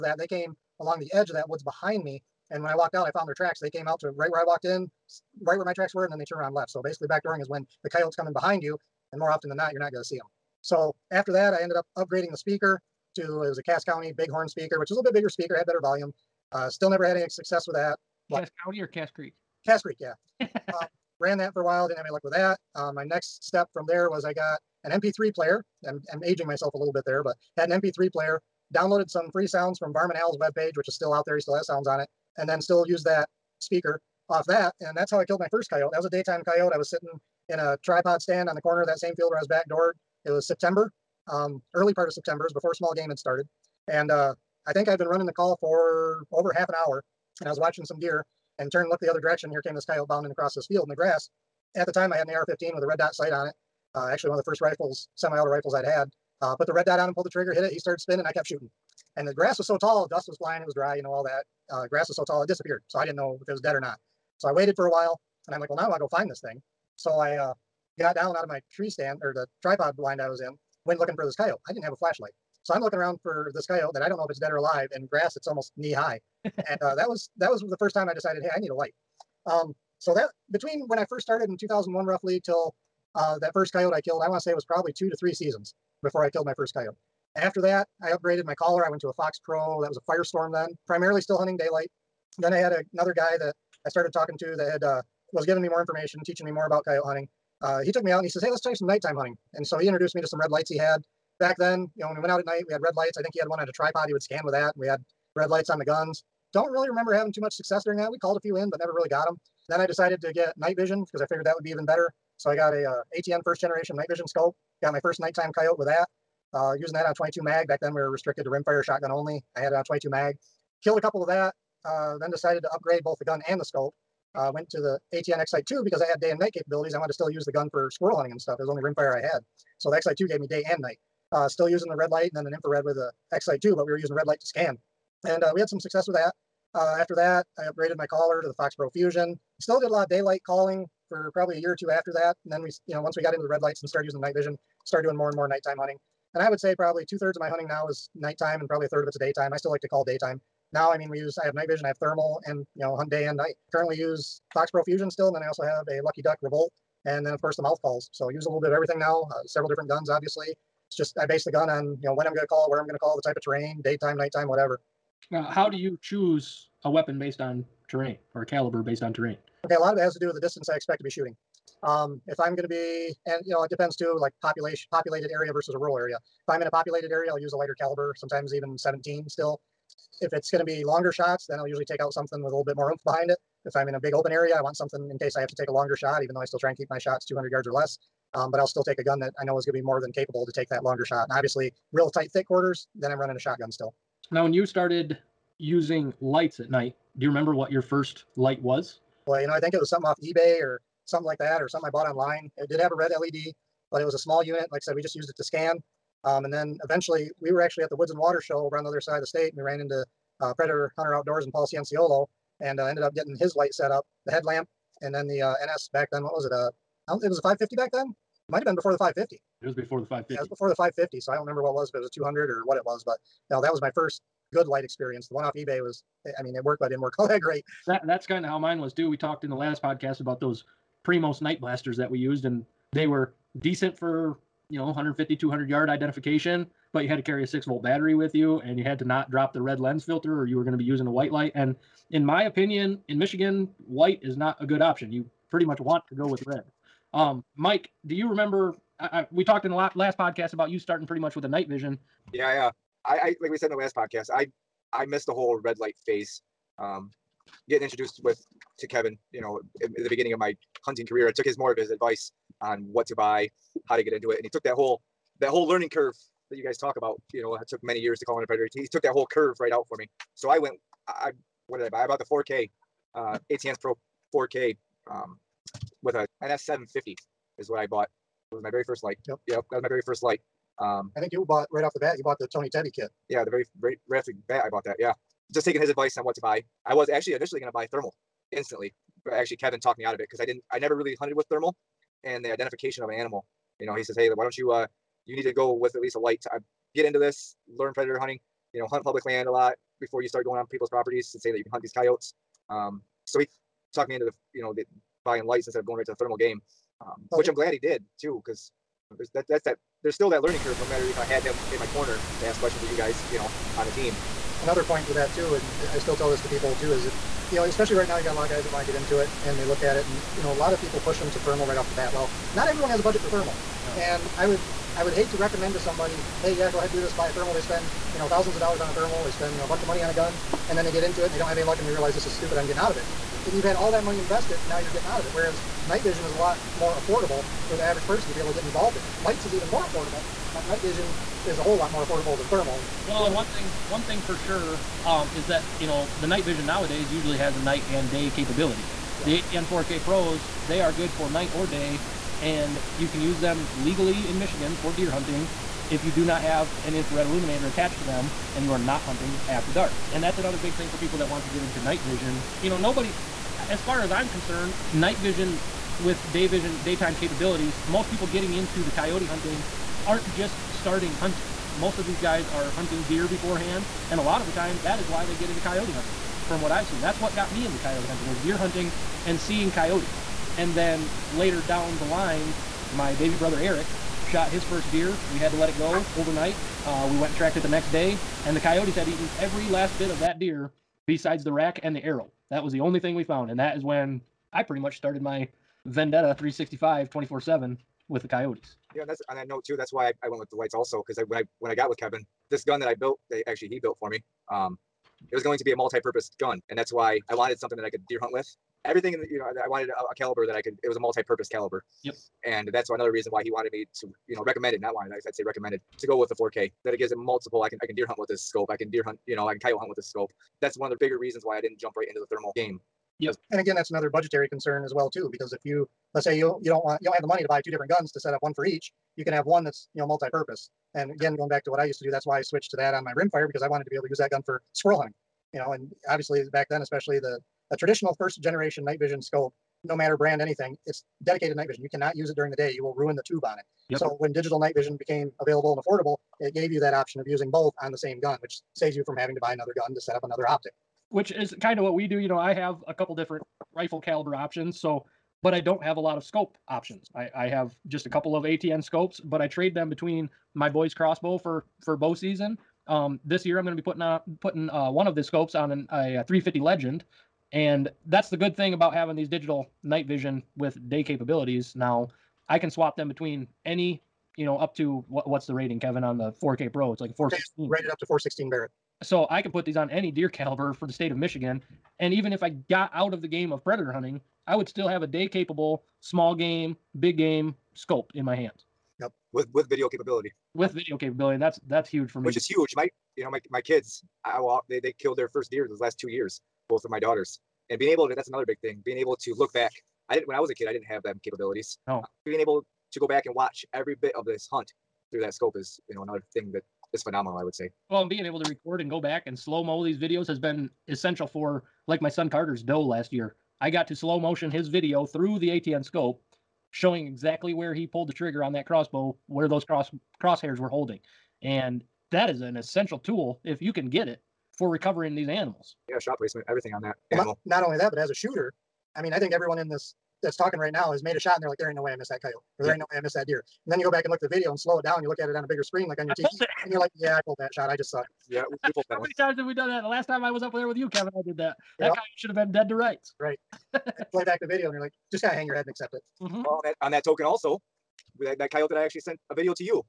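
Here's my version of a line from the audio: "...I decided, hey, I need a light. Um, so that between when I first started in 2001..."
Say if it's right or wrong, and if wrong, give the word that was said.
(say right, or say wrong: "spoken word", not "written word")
right.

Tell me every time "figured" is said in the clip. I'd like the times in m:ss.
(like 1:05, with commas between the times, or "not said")
1:51.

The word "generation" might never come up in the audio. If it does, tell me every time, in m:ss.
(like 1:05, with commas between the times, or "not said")
1:53, 7:18.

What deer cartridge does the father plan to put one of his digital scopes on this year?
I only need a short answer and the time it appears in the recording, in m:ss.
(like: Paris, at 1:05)
350 Legend, at 7:46.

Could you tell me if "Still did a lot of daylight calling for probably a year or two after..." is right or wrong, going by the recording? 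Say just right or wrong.
right.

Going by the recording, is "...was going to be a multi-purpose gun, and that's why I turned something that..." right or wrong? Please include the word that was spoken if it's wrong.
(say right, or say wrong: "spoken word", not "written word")
wrong: "wanted", not "turned".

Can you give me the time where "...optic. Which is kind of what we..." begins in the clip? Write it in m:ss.
7:30.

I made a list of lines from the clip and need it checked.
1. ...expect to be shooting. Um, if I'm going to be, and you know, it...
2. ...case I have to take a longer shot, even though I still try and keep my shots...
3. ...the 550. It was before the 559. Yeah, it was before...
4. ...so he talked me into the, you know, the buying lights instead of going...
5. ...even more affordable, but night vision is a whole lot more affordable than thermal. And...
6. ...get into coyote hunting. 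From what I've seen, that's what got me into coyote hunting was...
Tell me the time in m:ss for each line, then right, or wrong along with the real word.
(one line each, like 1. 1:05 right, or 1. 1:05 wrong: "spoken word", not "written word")
1. 2:50 right
2. 3:05 right
3. 3:38 wrong: "550", not "559"
4. 5:03 right
5. 5:39 right
6. 6:15 right.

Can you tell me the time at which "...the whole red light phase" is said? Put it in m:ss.
4:15.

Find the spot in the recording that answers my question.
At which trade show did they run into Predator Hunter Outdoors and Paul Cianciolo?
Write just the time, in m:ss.
3:27.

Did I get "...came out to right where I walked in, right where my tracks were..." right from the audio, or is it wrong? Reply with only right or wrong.
right.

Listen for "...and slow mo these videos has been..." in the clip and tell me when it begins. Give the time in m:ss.
8:29.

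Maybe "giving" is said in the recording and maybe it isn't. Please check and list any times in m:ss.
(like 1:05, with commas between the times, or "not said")
1:35.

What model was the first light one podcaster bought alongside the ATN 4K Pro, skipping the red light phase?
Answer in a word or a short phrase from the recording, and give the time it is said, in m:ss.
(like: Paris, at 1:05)
NS750, at 4:36.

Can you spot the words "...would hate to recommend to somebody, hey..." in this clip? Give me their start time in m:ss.
5:25.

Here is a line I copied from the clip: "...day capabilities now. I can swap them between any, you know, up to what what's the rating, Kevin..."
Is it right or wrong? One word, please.
right.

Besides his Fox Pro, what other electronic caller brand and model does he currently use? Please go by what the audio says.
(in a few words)
Lucky Duck Revolt.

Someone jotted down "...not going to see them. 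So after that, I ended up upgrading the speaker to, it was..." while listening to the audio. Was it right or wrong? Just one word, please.
right.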